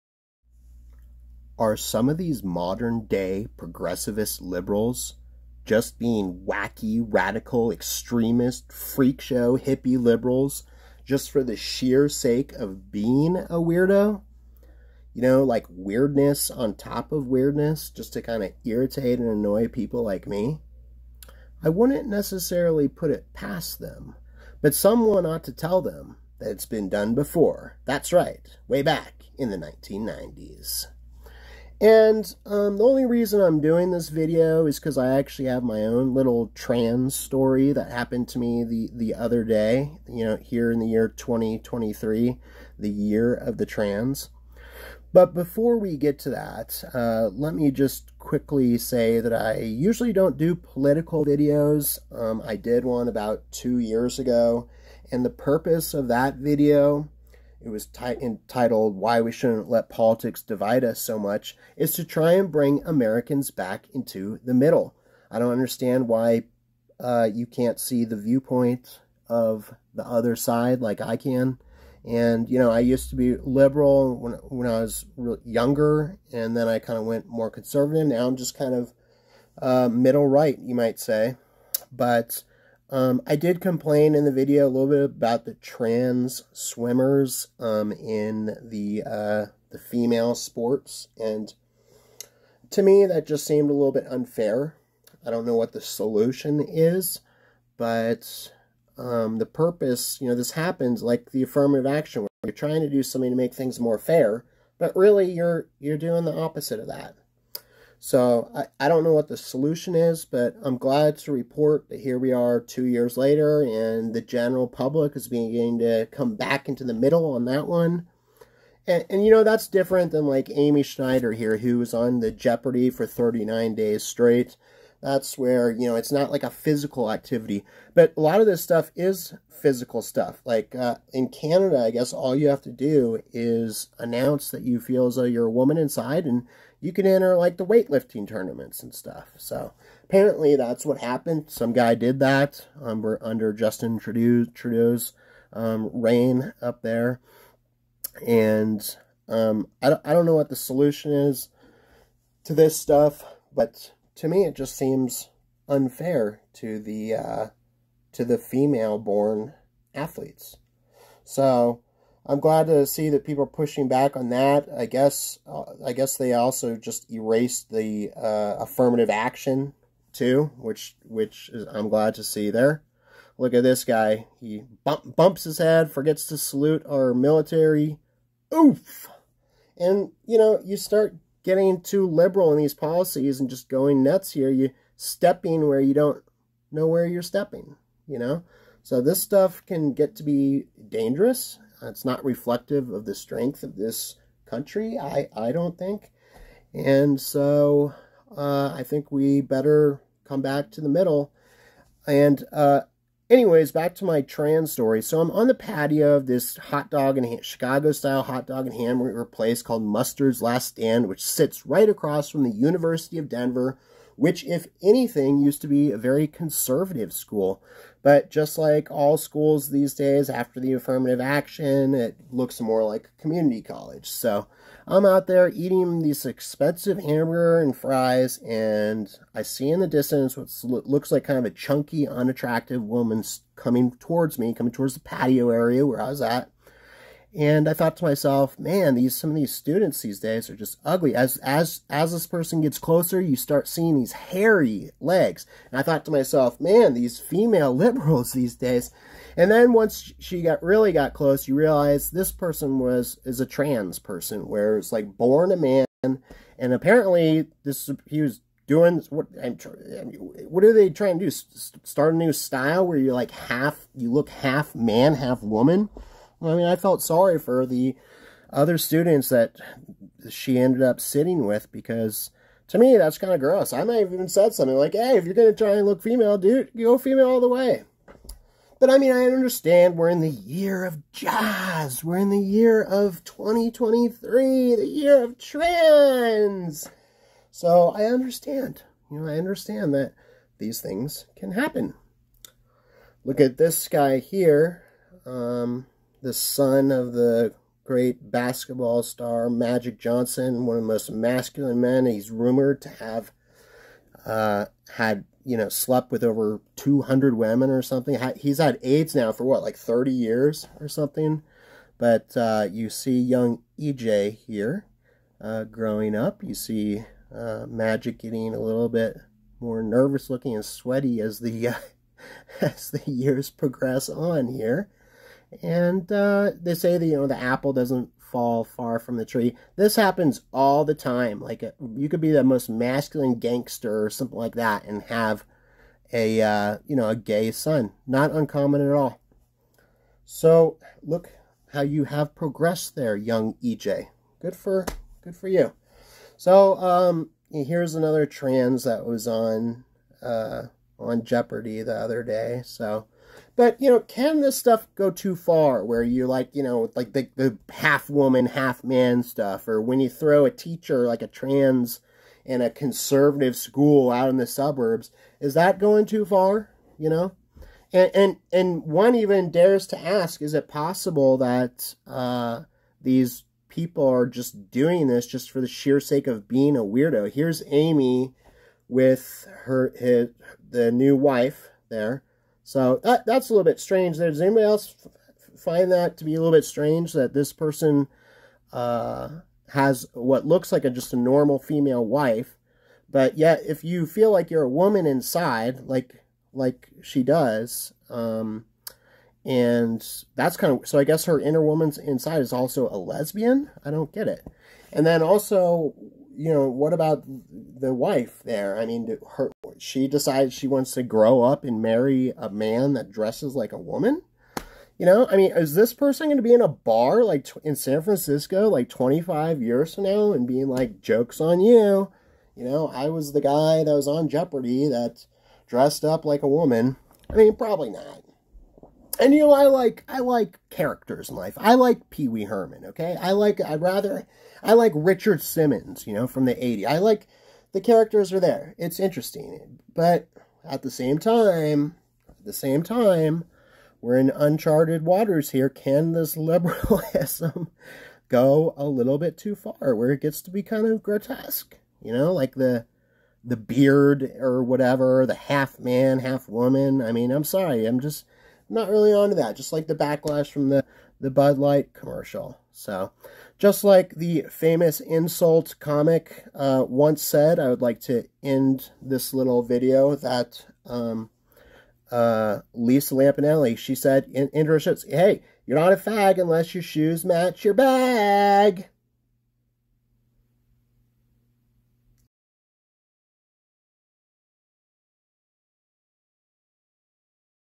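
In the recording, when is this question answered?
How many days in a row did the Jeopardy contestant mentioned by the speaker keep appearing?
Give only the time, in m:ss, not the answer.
2:03.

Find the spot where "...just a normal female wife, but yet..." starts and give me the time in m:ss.
6:30.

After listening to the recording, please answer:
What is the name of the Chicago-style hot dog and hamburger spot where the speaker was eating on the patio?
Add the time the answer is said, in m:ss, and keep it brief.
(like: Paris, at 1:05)
Mustard's Last Stand, at 3:29.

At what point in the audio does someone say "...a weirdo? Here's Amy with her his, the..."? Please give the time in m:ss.
6:16.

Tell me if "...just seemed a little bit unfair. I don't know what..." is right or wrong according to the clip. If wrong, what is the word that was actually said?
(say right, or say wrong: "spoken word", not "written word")
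right.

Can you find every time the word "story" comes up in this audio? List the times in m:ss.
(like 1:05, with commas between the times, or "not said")
0:37, 3:24.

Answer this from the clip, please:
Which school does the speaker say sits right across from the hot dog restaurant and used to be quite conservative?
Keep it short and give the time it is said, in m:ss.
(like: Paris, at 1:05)
University of Denver, at 3:32.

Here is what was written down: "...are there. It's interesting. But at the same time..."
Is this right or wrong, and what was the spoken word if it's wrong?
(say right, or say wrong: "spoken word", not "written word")
right.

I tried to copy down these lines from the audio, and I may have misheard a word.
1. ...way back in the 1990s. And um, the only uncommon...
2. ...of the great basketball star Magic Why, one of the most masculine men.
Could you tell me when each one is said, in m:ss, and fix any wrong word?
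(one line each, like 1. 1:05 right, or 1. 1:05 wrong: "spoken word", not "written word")
1. 0:28 wrong: "reason", not "uncommon"
2. 4:56 wrong: "Johnson", not "Why".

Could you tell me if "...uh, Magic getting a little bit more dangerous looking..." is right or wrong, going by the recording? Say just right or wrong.
wrong.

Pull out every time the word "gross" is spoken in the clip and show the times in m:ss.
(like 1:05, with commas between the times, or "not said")
4:33.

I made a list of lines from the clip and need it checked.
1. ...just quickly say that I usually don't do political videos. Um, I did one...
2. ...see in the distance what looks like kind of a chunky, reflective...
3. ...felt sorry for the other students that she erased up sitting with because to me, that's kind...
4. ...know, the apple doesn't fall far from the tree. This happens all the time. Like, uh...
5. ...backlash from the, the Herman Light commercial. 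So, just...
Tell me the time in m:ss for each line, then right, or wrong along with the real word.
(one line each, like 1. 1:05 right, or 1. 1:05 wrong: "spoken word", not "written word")
1. 0:47 right
2. 3:49 wrong: "unattractive", not "reflective"
3. 4:26 wrong: "ended", not "erased"
4. 5:27 right
5. 7:39 wrong: "Bud", not "Herman".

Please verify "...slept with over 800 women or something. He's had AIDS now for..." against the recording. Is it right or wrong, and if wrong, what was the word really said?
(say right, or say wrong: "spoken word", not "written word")
wrong: "200", not "800".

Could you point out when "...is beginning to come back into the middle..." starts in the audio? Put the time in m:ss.
1:55.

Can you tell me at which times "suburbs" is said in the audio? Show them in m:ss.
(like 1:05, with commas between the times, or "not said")
6:04.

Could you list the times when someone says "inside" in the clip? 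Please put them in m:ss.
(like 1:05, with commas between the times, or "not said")
2:15, 6:35, 6:41.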